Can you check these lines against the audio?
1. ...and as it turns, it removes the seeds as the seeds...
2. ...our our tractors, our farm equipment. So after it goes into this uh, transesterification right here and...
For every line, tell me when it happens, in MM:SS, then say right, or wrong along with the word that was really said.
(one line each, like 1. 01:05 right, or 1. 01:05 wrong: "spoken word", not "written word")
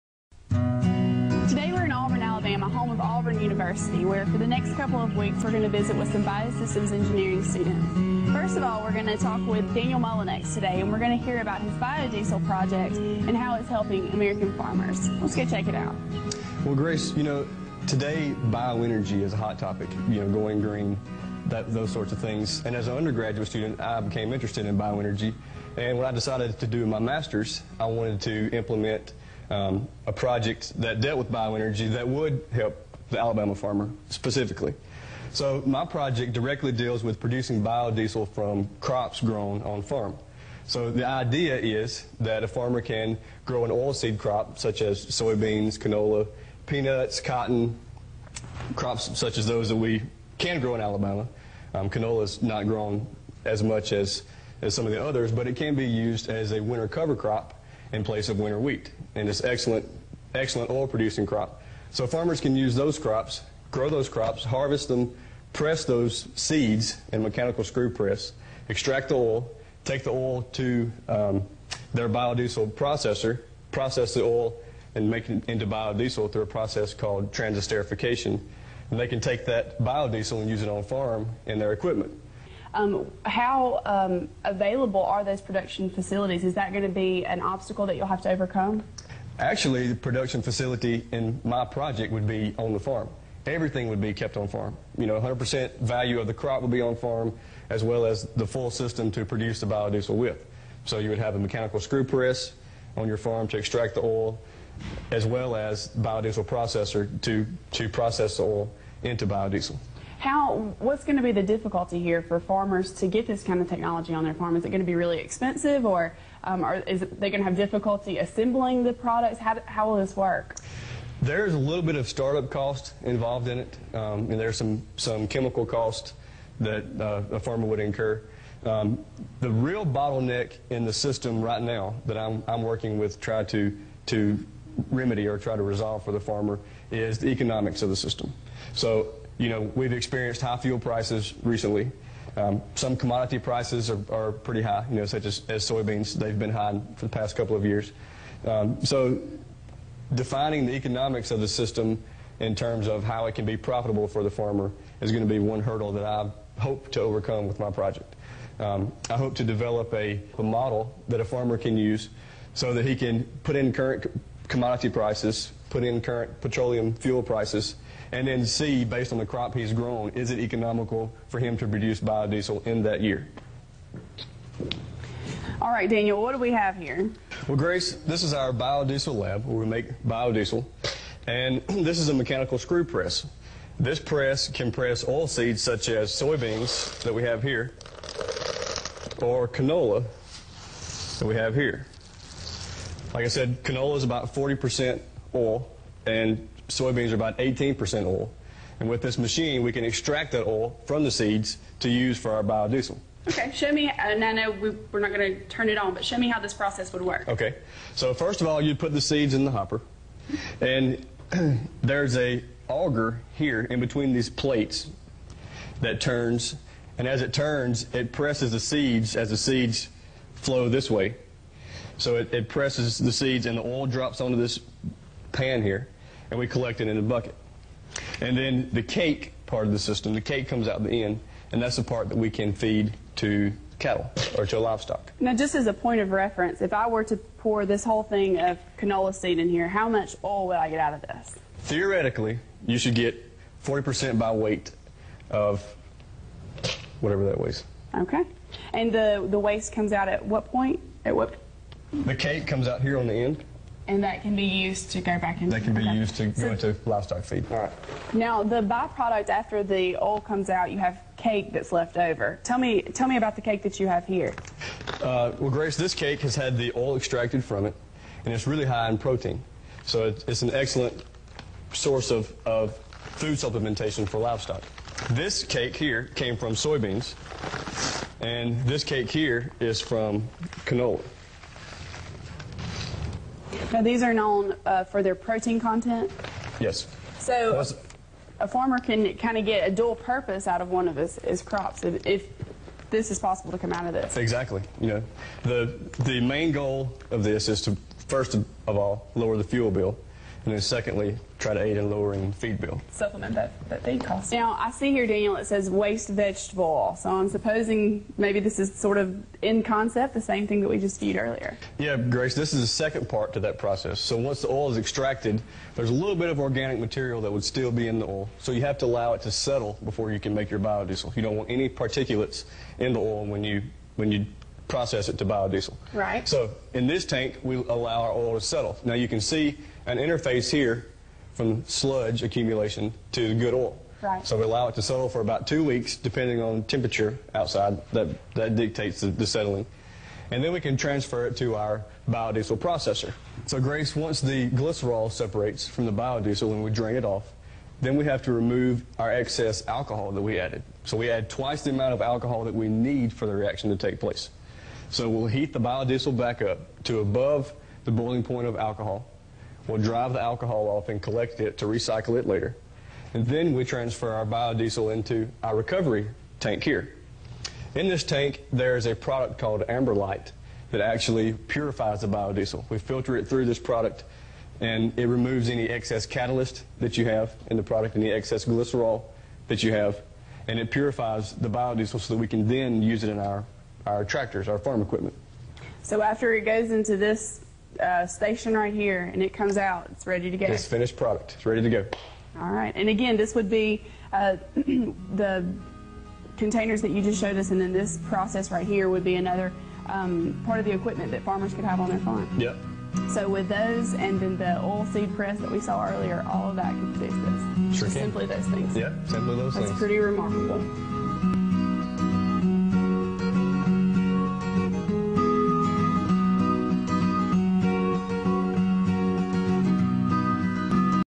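1. 03:36 wrong: "presses", not "removes"
2. 06:23 wrong: "station", not "transesterification".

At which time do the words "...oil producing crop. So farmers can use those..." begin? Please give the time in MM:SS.
01:00.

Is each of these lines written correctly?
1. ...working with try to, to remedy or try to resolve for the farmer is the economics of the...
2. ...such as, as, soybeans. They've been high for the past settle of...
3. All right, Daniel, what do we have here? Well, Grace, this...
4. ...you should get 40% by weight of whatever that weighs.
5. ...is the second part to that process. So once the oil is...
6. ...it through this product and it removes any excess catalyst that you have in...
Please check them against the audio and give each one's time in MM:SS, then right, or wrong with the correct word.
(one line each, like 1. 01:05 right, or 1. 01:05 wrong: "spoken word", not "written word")
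1. 02:12 right
2. 02:25 wrong: "couple", not "settle"
3. 02:55 right
4. 04:02 right
5. 05:12 right
6. 06:13 right.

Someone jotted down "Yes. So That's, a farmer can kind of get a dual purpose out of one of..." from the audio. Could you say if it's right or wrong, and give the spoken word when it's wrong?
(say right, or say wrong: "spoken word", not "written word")
right.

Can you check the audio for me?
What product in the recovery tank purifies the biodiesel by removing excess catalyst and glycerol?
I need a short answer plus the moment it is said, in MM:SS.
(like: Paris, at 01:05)
Amberlite, at 06:09.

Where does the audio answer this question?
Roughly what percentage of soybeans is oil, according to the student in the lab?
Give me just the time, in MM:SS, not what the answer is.
03:17.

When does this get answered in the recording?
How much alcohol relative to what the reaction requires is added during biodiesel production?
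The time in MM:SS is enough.
05:51.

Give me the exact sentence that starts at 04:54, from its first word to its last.
You know, the the main goal of this is to first of all lower the fuel bill.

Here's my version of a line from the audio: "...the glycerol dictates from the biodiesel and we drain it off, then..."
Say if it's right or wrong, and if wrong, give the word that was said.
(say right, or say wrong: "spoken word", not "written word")
wrong: "separates", not "dictates".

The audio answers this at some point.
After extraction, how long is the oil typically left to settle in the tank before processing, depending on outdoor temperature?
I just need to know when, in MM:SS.
05:35.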